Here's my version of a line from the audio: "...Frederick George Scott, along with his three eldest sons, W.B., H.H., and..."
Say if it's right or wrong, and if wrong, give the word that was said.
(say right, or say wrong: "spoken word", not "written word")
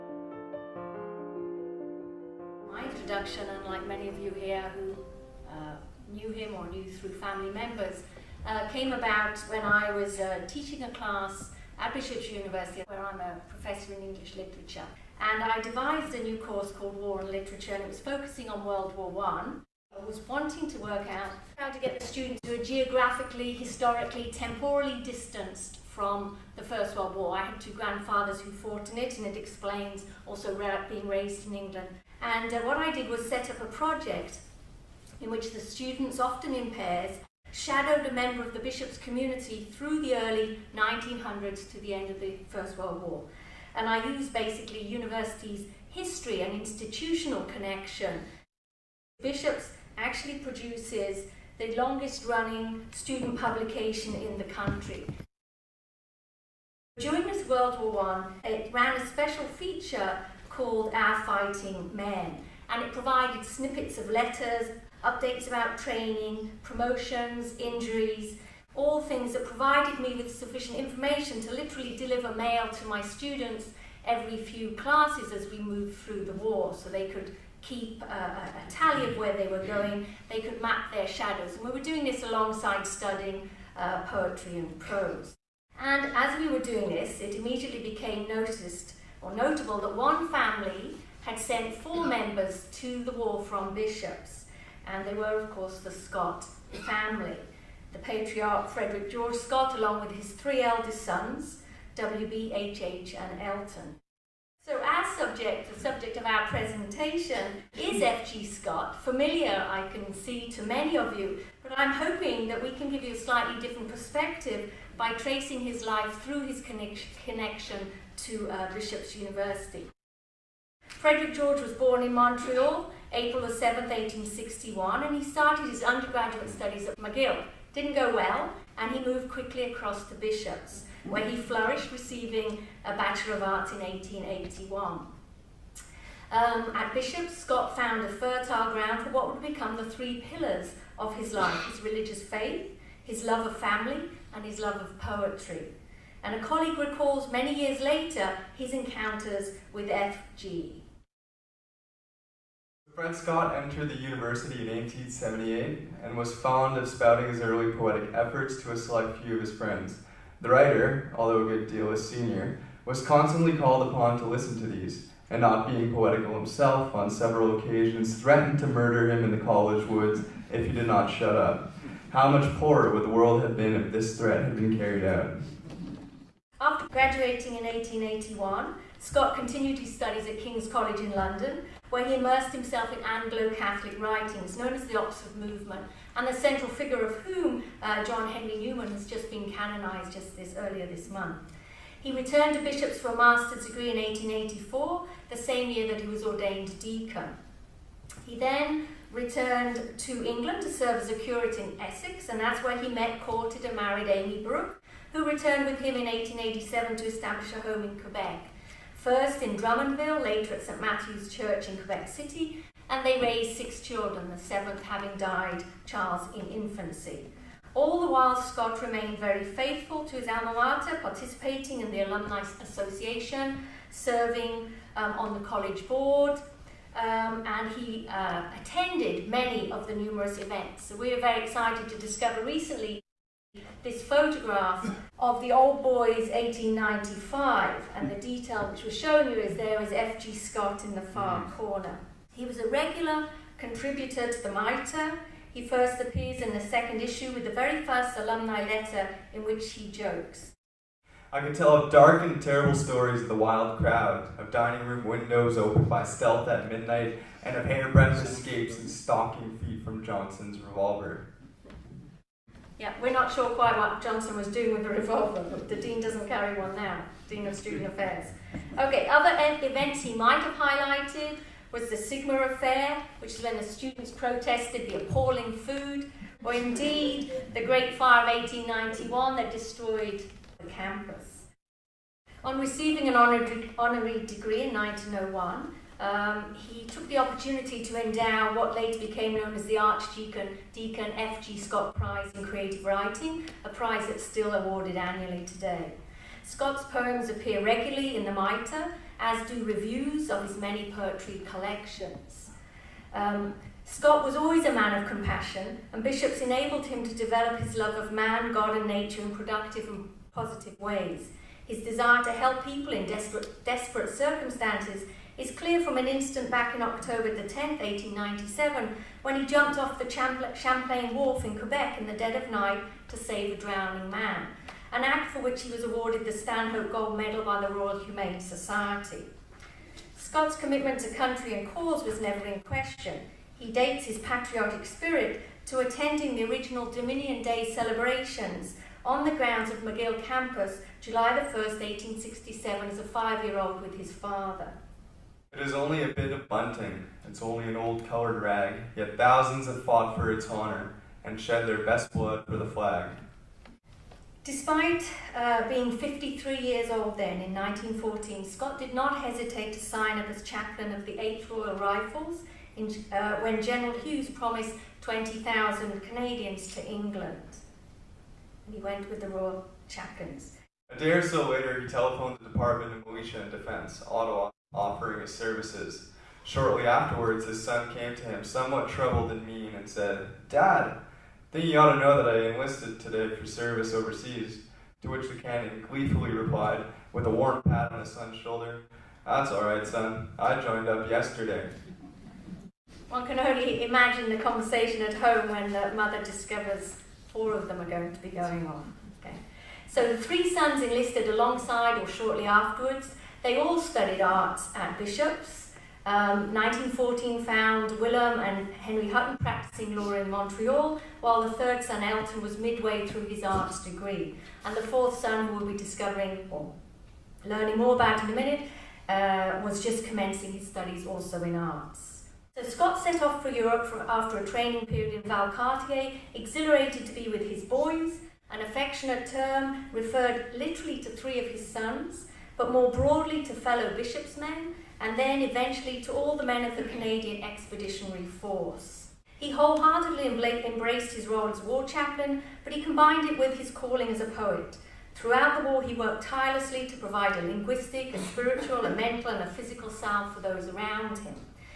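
right.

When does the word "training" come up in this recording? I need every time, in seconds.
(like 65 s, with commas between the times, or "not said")
65 s, 424 s.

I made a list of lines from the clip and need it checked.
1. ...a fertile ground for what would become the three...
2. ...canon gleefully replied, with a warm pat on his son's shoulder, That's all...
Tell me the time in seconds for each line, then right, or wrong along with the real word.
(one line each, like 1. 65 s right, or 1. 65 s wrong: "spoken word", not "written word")
1. 138 s right
2. 385 s right.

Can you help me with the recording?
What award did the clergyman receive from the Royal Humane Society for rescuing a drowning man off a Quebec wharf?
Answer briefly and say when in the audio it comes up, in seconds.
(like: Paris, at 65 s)
Stanhope Gold Medal, at 326 s.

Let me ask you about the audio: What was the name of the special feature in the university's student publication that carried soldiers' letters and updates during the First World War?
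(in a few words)
Our Fighting Men.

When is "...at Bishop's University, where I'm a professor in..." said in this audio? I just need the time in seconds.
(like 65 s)
11 s.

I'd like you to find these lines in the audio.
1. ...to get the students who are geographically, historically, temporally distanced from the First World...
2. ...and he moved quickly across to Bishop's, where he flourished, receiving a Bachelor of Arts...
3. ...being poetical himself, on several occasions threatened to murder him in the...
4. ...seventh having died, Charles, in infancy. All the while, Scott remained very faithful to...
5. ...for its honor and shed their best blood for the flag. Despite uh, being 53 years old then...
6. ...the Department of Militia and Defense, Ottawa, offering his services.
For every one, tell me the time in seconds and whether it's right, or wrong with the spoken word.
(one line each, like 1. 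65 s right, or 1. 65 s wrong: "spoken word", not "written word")
1. 21 s right
2. 128 s right
3. 165 s right
4. 214 s right
5. 350 s right
6. 372 s right.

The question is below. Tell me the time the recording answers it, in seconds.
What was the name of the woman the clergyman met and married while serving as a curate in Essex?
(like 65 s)
204 s.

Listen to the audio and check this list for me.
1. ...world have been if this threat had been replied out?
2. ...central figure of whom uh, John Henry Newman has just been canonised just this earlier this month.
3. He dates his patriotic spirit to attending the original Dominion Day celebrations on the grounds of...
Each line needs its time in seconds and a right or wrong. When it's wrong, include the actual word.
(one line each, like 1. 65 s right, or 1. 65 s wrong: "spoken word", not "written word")
1. 173 s wrong: "carried", not "replied"
2. 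186 s right
3. 333 s right.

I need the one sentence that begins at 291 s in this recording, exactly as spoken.
Scott Prize in Creative Writing, a prize that's still awarded annually today.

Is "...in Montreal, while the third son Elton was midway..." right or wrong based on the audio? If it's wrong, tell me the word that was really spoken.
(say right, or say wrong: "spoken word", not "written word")
right.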